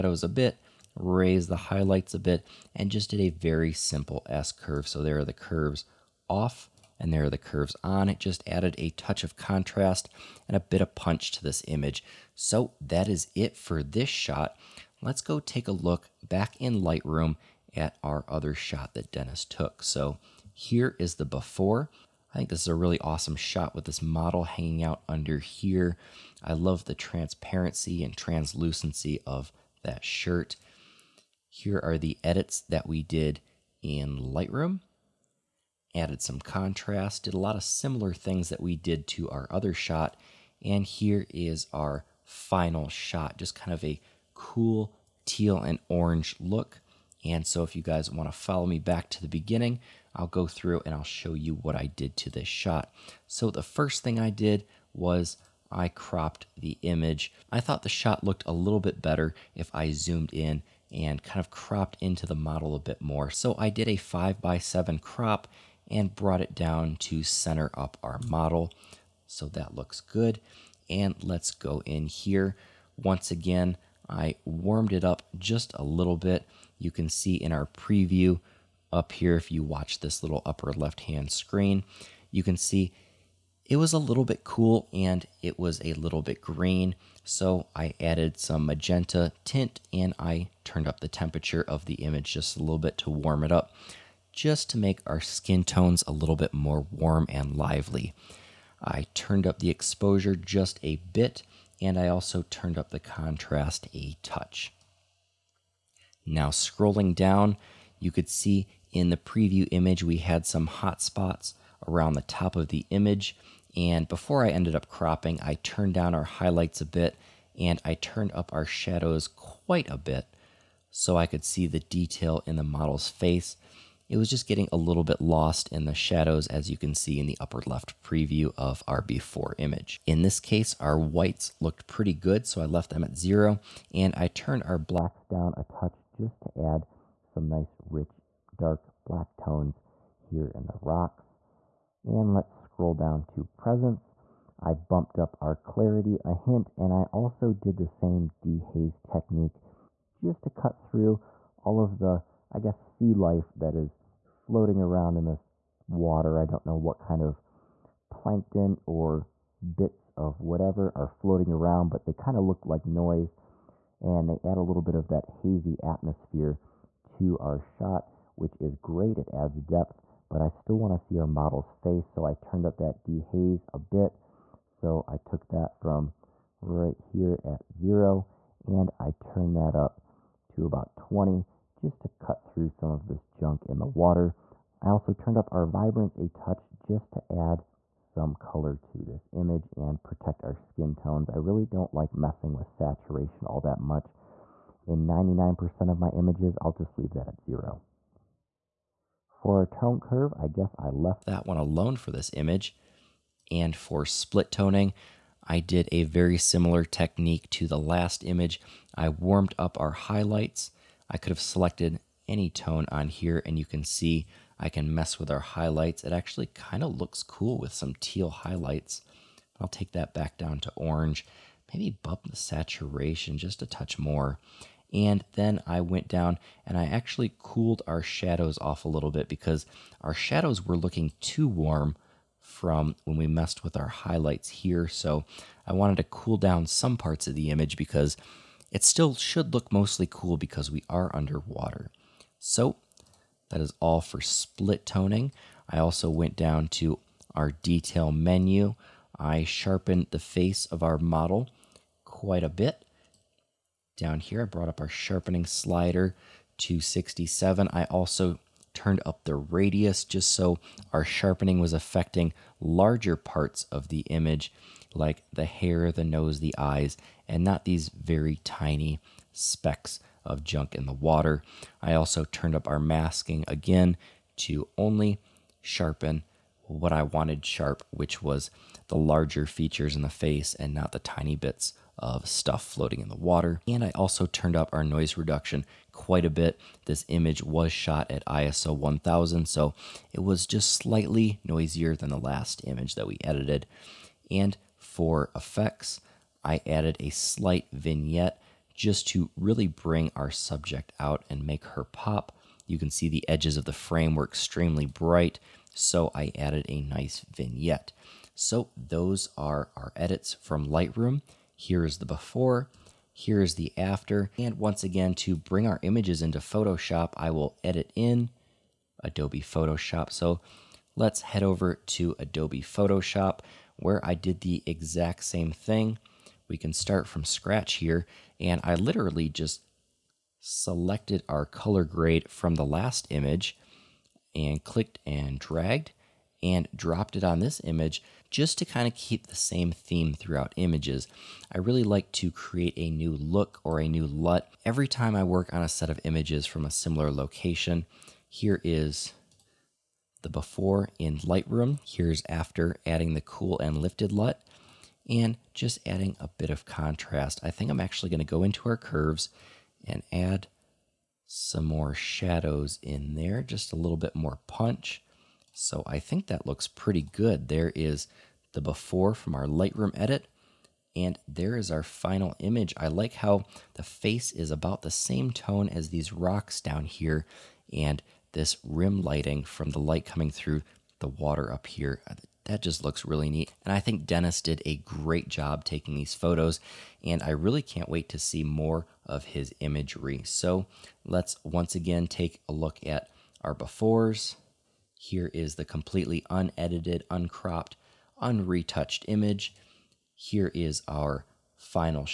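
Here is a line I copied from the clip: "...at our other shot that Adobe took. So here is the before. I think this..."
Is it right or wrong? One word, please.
wrong.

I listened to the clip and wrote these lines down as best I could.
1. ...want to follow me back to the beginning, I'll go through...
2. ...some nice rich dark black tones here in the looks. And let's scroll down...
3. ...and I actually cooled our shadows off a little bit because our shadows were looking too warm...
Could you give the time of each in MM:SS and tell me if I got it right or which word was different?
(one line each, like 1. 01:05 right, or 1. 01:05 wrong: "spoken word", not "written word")
1. 00:48 right
2. 02:17 wrong: "rocks", not "looks"
3. 03:46 right.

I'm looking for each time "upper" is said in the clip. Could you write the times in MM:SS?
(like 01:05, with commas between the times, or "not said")
01:20, 02:07.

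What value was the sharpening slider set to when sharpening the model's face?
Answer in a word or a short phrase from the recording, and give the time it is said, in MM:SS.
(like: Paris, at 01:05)
67, at 04:16.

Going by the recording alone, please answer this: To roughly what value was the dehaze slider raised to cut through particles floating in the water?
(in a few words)
20.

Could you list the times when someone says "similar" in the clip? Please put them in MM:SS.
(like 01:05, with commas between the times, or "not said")
00:37, 03:26, 05:46.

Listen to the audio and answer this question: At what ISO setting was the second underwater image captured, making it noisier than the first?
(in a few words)
ISO 1000.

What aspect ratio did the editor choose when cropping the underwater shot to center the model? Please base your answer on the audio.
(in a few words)
5 by 7.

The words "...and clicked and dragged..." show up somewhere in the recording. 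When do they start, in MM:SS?
05:34.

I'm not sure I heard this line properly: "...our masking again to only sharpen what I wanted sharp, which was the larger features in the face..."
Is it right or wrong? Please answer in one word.
right.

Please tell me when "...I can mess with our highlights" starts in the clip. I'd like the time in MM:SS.
03:34.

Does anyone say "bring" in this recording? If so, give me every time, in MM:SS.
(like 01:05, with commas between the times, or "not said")
04:59, 05:15.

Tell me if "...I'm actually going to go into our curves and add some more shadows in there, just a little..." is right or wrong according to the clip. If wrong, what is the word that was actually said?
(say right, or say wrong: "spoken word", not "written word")
right.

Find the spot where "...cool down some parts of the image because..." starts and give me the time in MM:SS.
03:56.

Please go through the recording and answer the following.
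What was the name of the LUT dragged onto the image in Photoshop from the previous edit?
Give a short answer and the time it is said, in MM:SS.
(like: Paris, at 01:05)
cool and lifted, at 05:53.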